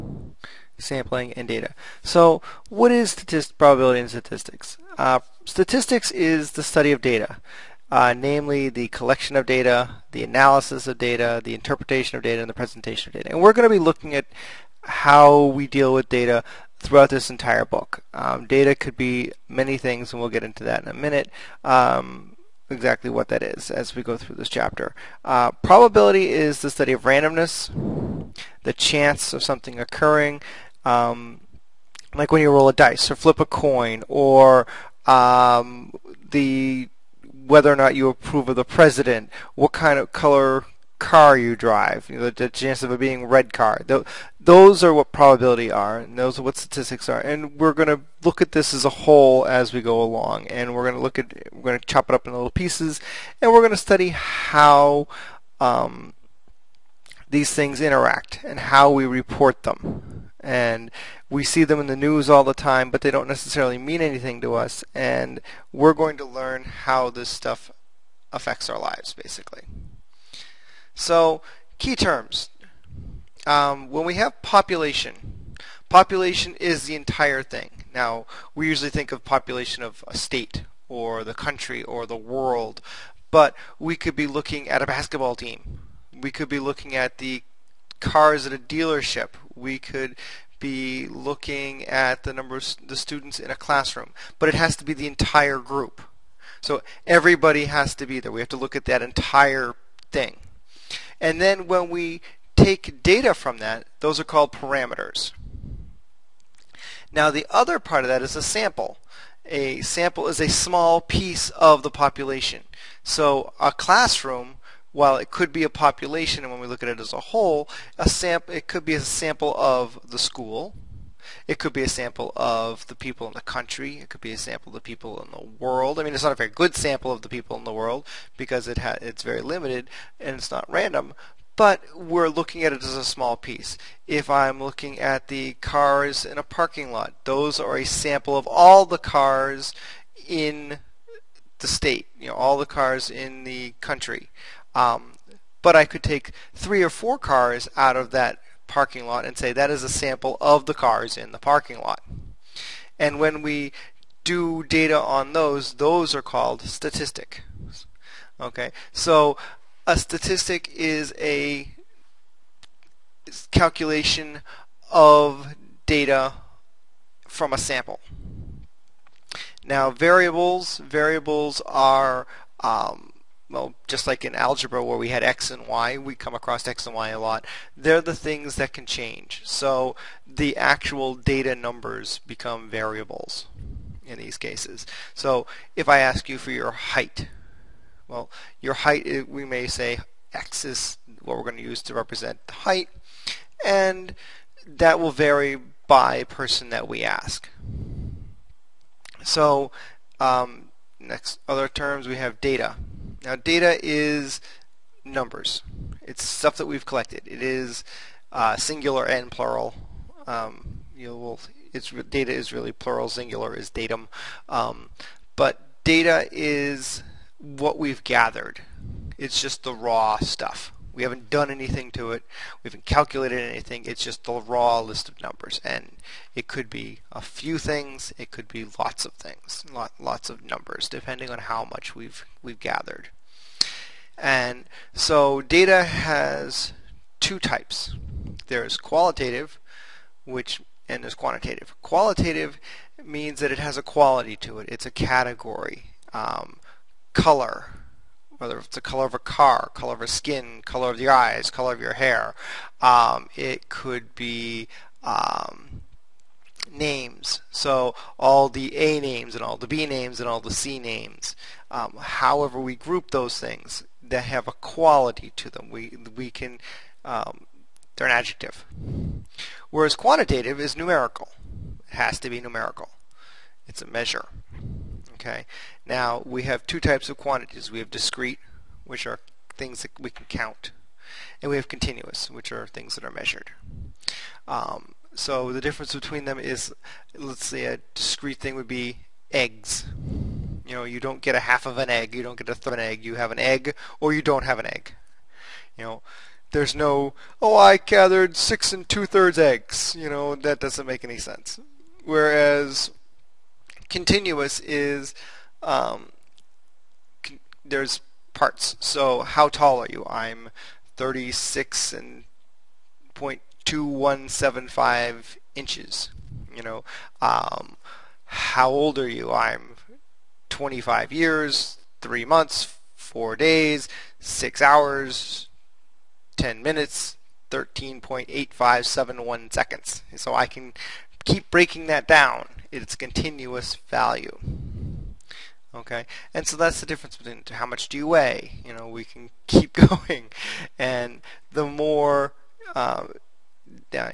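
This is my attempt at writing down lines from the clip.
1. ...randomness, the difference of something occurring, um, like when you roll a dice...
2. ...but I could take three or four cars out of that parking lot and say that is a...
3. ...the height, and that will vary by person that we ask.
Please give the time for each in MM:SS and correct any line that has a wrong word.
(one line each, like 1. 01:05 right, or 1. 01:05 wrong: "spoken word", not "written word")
1. 00:27 wrong: "chance", not "difference"
2. 02:25 right
3. 03:12 right.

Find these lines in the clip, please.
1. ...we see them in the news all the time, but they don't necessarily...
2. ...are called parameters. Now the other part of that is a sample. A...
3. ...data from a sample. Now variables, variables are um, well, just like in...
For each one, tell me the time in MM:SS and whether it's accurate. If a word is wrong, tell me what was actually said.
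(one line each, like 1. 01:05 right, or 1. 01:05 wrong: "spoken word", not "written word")
1. 01:01 right
2. 01:44 right
3. 02:45 right.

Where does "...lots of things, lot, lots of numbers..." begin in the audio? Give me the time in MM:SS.
03:48.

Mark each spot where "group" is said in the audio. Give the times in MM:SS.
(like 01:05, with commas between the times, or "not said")
01:35, 04:22.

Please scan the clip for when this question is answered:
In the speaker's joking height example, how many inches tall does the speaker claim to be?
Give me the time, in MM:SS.
05:10.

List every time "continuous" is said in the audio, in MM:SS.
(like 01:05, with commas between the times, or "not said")
04:41, 05:03, 05:32.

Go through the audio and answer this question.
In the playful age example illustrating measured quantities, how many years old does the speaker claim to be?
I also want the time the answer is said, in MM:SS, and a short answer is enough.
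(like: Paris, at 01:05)
25, at 05:20.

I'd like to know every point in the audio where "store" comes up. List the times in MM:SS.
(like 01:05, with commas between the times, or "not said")
not said.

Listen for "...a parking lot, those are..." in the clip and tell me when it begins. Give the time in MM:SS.
02:16.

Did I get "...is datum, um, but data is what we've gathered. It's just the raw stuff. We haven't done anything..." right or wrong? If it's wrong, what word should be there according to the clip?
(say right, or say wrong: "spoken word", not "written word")
right.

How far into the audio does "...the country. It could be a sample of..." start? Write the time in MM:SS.
02:03.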